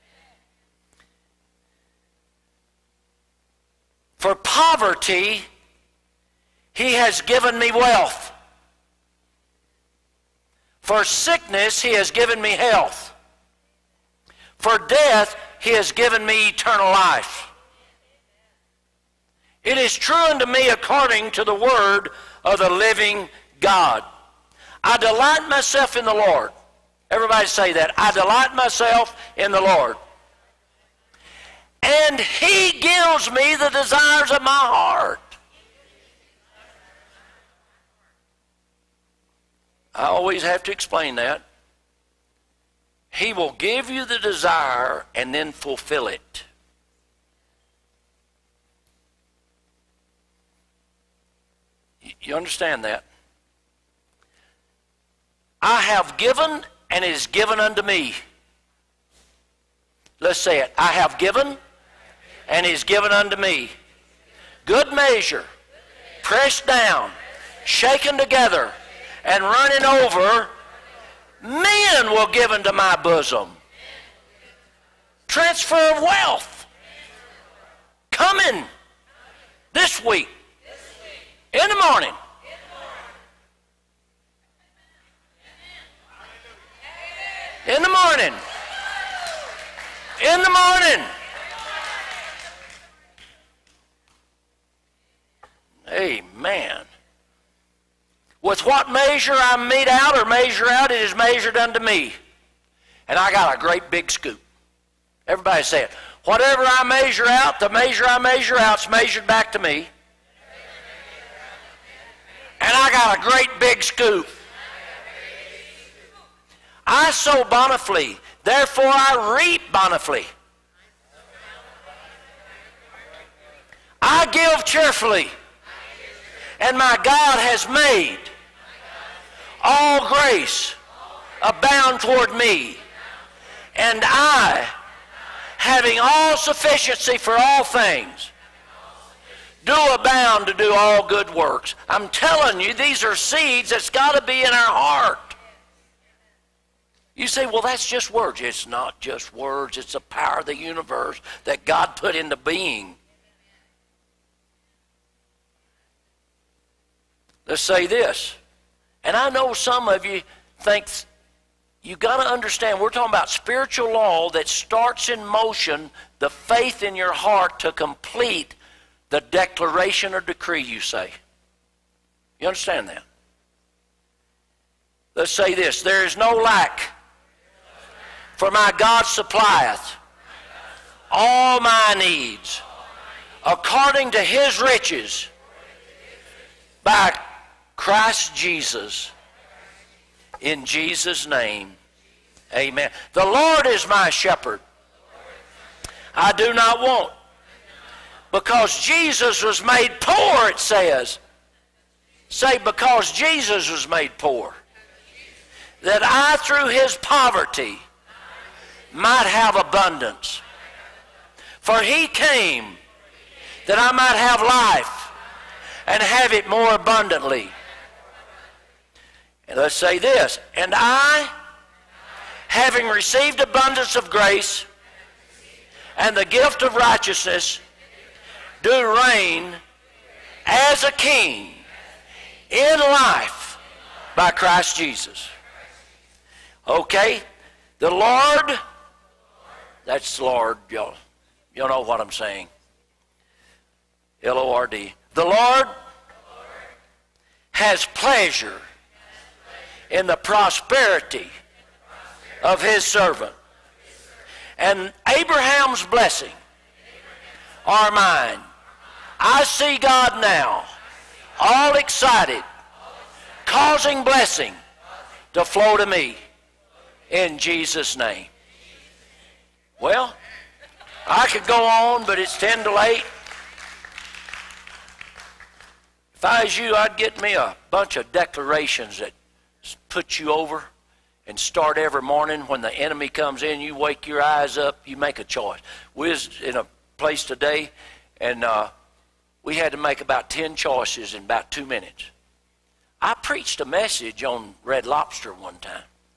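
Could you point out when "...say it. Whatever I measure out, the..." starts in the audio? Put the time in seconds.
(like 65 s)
105 s.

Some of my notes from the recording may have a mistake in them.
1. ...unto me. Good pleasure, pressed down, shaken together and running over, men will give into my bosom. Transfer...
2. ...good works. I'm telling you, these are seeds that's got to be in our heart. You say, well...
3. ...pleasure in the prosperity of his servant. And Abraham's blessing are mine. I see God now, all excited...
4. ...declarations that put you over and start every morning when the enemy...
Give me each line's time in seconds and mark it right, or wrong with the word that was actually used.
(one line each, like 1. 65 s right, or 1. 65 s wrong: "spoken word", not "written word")
1. 63 s wrong: "measure", not "pleasure"
2. 141 s right
3. 247 s right
4. 278 s right.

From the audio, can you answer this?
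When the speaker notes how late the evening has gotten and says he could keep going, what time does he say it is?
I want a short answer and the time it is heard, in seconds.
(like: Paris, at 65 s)
10 to 8, at 272 s.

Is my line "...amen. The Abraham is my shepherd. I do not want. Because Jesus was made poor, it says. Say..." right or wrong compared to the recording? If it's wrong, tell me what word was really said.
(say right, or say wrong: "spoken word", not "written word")
wrong: "Lord", not "Abraham".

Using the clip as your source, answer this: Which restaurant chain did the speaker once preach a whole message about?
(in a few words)
Red Lobster.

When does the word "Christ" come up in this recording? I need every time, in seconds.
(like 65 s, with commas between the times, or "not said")
187 s, 234 s.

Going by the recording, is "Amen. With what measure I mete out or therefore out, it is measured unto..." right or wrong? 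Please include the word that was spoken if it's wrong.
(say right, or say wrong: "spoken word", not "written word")
wrong: "measure", not "therefore".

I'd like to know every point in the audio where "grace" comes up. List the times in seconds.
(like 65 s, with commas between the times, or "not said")
130 s, 224 s.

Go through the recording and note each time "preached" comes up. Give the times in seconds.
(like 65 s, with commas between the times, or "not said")
293 s.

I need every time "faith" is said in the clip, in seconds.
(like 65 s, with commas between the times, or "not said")
166 s.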